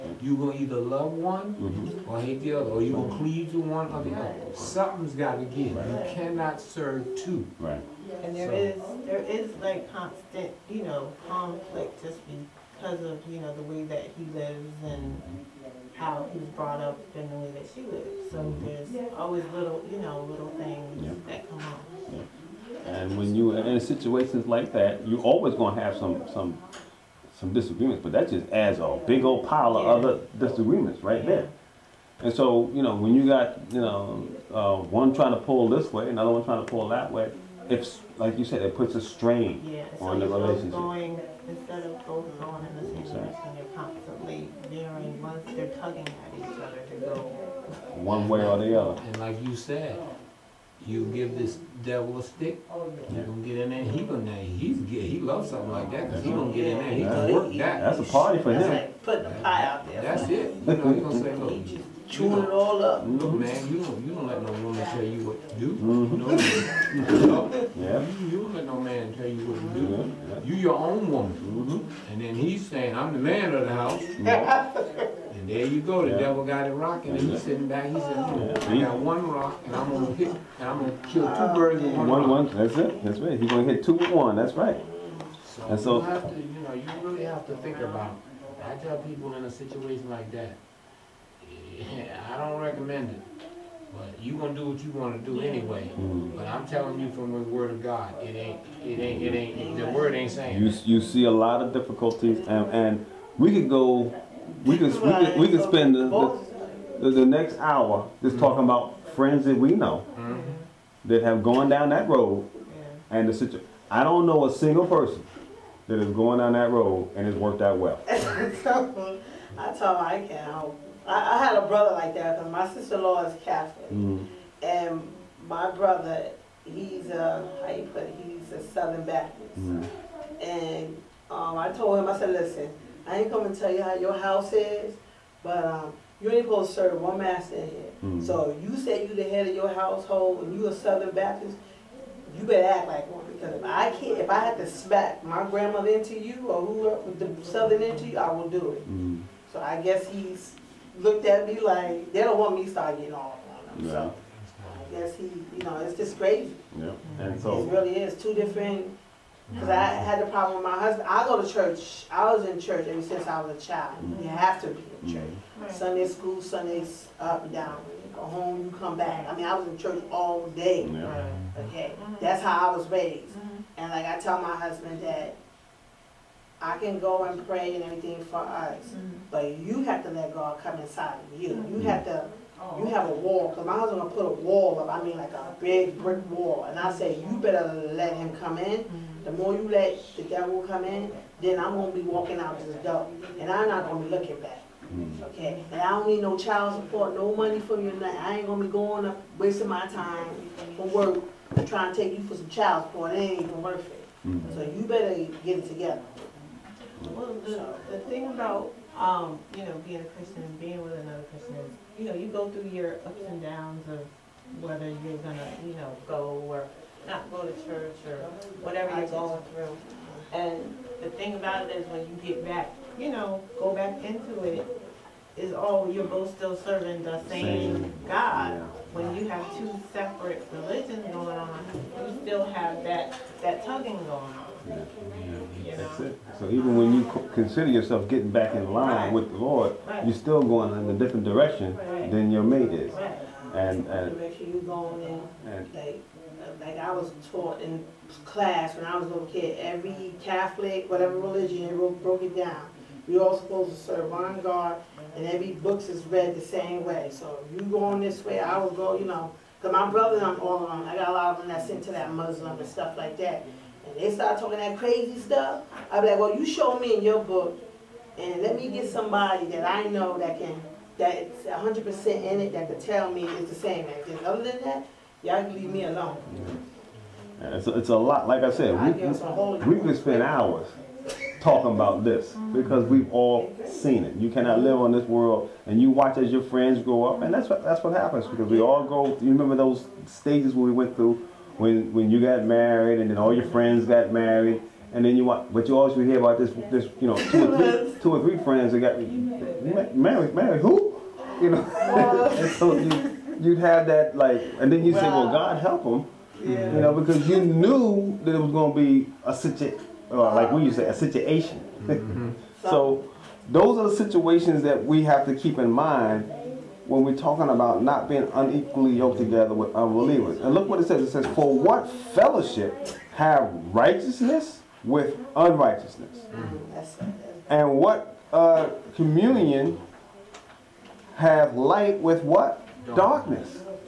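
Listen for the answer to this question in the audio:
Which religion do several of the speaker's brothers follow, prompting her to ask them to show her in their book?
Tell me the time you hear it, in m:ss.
4:22.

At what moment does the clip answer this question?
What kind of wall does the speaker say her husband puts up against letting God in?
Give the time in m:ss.
3:05.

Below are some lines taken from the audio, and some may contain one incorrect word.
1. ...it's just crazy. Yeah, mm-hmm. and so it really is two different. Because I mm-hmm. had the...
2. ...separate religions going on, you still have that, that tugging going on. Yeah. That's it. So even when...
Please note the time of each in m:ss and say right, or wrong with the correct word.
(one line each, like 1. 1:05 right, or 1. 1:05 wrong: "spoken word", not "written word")
1. 2:35 right
2. 3:49 right.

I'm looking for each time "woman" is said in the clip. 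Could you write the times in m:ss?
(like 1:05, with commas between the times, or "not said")
1:04, 1:11.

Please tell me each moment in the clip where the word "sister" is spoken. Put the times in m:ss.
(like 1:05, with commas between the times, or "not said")
2:02.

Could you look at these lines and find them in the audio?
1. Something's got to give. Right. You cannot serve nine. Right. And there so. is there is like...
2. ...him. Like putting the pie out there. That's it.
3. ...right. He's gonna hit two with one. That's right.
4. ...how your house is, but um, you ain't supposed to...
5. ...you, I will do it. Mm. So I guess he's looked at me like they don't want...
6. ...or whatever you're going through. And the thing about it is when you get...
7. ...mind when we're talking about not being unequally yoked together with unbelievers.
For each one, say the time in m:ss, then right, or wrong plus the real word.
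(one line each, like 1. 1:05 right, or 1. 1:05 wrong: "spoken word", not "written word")
1. 0:04 wrong: "two", not "nine"
2. 0:58 right
3. 1:23 right
4. 2:13 right
5. 2:28 right
6. 3:38 right
7. 5:15 right.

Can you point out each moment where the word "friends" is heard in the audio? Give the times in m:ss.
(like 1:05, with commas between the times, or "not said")
1:49, 4:46, 4:53, 4:58.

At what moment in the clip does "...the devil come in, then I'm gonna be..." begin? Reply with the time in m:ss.
3:10.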